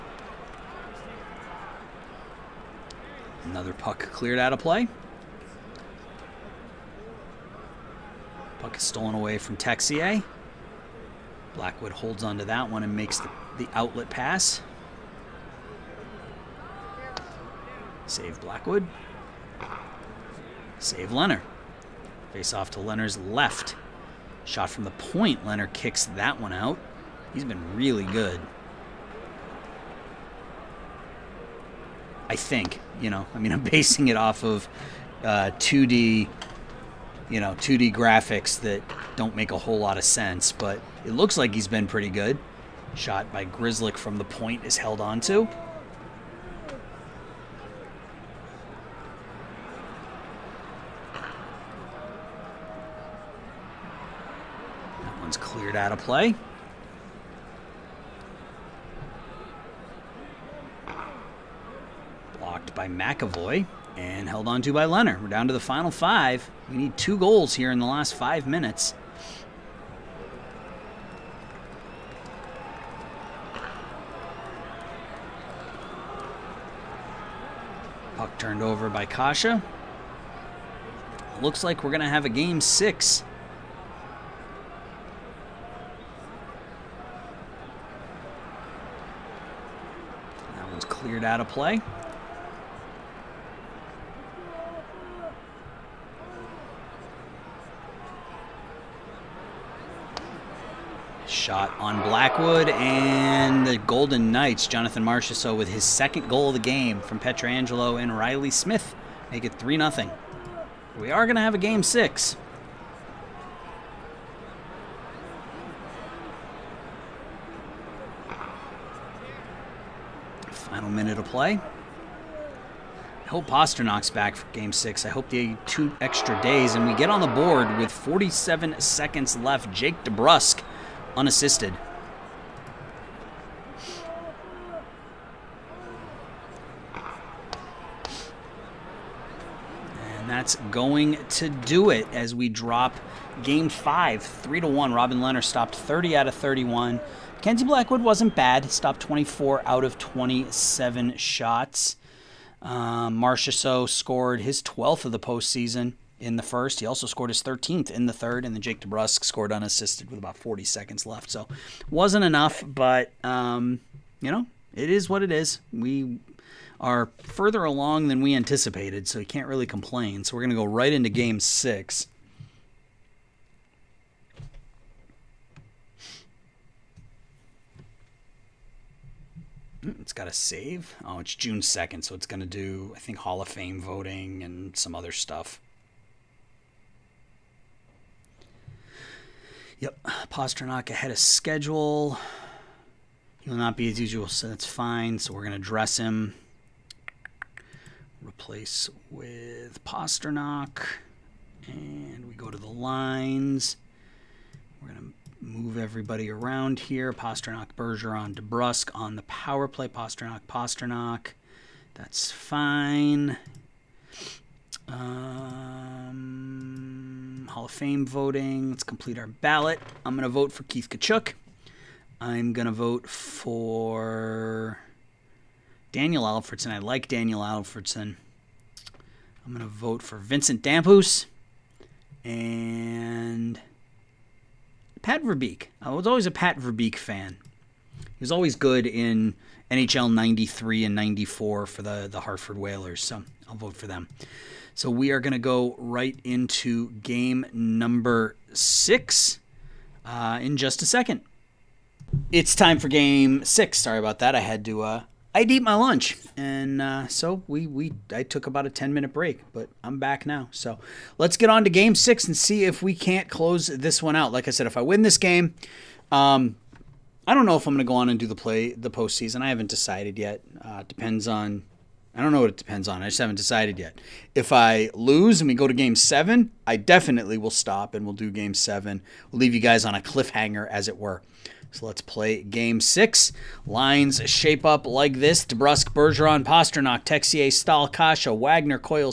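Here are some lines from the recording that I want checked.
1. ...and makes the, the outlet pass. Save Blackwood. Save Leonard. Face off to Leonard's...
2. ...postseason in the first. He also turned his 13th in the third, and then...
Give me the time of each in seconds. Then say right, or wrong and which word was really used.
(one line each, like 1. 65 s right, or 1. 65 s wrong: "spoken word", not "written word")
1. 12 s right
2. 155 s wrong: "scored", not "turned".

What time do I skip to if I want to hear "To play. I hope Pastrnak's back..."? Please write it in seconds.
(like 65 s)
121 s.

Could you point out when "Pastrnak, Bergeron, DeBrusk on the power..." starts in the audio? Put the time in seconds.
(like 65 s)
207 s.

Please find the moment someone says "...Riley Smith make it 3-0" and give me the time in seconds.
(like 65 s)
108 s.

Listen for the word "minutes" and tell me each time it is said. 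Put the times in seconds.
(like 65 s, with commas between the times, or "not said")
68 s, 258 s.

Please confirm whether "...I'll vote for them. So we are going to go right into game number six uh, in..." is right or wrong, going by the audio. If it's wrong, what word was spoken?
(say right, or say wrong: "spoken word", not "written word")
right.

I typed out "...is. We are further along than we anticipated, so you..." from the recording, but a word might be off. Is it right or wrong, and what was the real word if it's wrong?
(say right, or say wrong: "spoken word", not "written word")
right.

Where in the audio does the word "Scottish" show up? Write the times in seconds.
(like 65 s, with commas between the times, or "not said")
not said.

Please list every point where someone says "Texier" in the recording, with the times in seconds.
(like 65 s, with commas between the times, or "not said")
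9 s, 287 s.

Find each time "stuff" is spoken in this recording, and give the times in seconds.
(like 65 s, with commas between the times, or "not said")
185 s.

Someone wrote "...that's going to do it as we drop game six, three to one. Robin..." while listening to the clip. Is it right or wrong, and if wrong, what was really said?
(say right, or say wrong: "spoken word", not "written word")
wrong: "five", not "six".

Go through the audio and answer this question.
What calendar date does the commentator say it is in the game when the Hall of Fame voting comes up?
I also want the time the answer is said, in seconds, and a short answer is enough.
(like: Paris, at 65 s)
June 2nd, at 181 s.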